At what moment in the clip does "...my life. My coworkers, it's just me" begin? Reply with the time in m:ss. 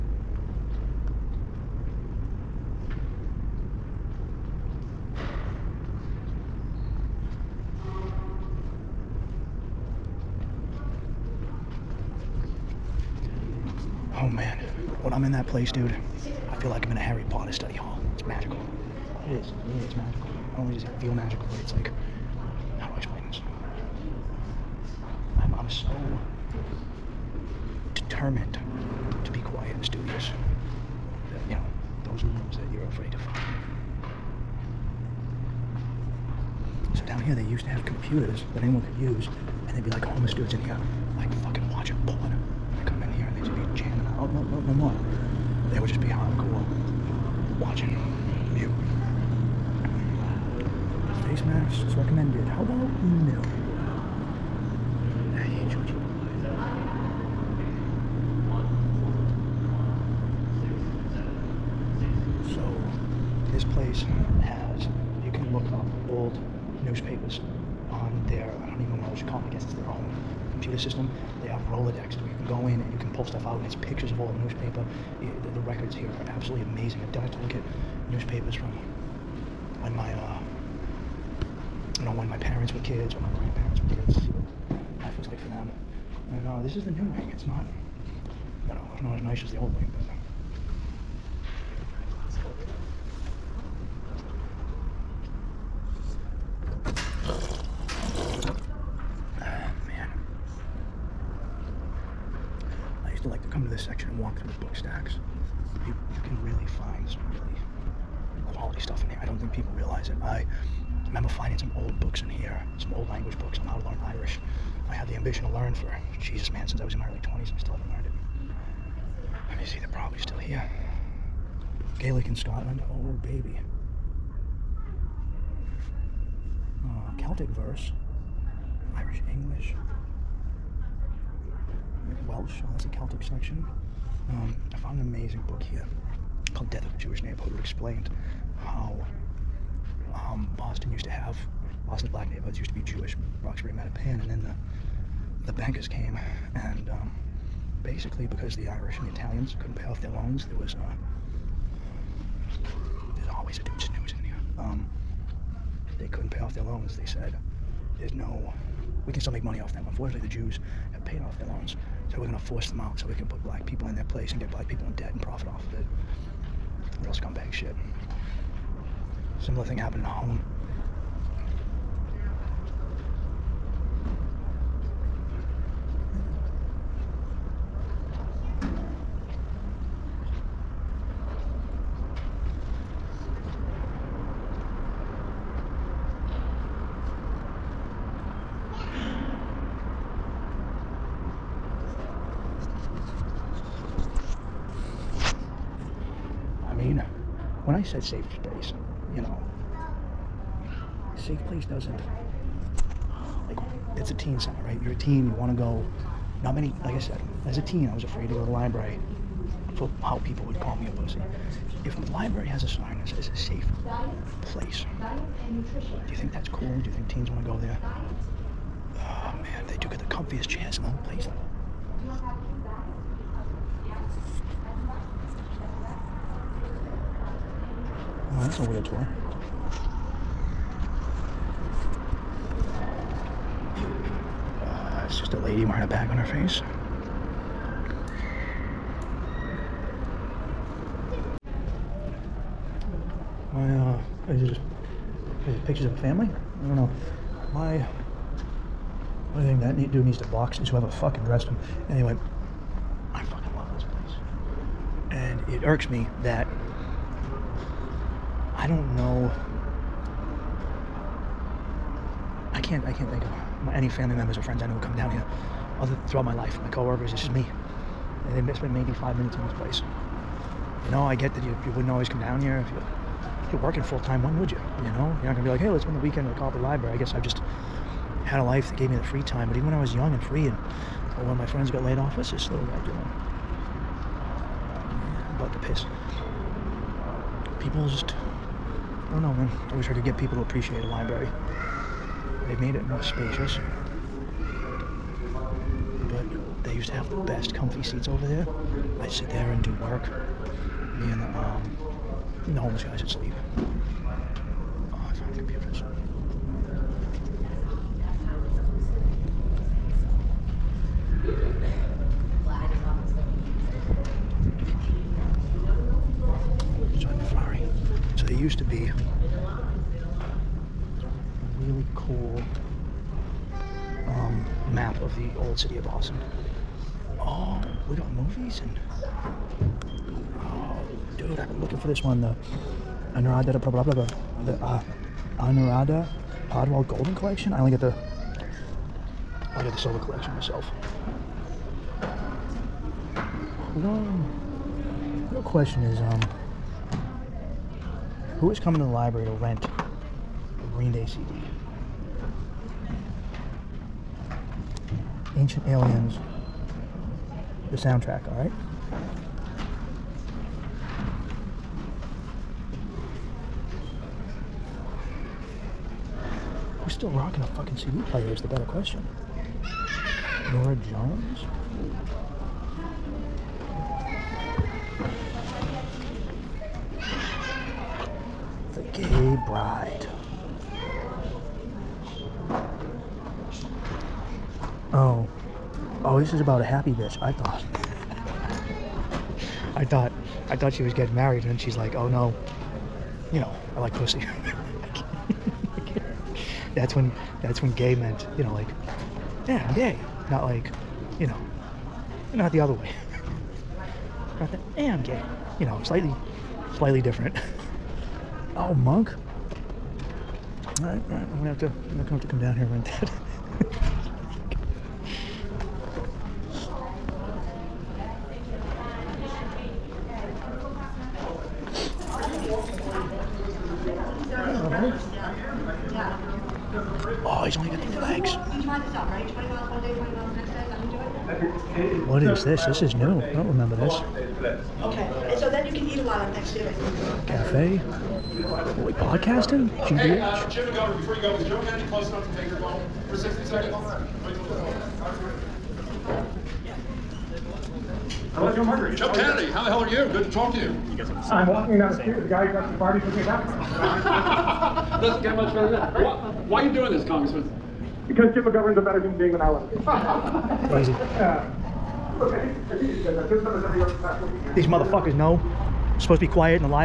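4:26.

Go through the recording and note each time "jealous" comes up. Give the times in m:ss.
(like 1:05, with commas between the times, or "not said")
not said.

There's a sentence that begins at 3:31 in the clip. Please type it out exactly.
If the library has a sign that says safe place, do you think that's cool?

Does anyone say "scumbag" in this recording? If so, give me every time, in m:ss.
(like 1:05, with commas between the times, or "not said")
2:47.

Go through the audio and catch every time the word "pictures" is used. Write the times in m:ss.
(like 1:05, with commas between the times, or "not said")
1:13, 4:05.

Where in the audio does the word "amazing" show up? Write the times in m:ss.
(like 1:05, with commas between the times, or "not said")
1:16, 2:15.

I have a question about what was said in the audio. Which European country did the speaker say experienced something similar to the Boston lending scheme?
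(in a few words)
Holland.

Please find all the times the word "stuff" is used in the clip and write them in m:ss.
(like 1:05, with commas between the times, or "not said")
1:13, 1:48.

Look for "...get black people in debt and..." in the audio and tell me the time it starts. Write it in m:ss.
2:44.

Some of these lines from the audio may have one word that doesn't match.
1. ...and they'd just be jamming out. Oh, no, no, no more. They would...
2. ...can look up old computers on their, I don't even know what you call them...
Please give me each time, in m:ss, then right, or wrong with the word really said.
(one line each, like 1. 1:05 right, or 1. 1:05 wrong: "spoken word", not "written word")
1. 0:43 right
2. 1:05 wrong: "newspapers", not "computers".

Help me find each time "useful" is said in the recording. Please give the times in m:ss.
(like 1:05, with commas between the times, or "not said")
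not said.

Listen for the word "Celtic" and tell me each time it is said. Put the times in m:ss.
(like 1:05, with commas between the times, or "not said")
2:07, 2:12.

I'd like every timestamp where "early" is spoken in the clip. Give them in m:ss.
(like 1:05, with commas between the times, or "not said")
1:57.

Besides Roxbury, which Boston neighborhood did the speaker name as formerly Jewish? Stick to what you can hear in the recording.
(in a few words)
Mattapan.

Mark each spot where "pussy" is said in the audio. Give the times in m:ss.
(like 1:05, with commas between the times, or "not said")
3:30, 6:33.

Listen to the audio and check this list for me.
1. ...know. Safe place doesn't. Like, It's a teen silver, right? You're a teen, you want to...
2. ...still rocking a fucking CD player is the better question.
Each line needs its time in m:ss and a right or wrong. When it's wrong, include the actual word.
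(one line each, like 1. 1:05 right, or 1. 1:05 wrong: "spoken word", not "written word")
1. 3:19 wrong: "center", not "silver"
2. 6:06 right.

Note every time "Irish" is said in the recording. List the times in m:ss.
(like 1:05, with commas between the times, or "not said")
1:54, 2:08, 2:28.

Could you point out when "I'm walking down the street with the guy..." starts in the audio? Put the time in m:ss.
7:31.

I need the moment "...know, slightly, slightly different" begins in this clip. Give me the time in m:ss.
6:45.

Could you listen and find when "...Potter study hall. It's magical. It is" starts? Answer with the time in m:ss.
0:17.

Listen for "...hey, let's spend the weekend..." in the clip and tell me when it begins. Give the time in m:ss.
4:35.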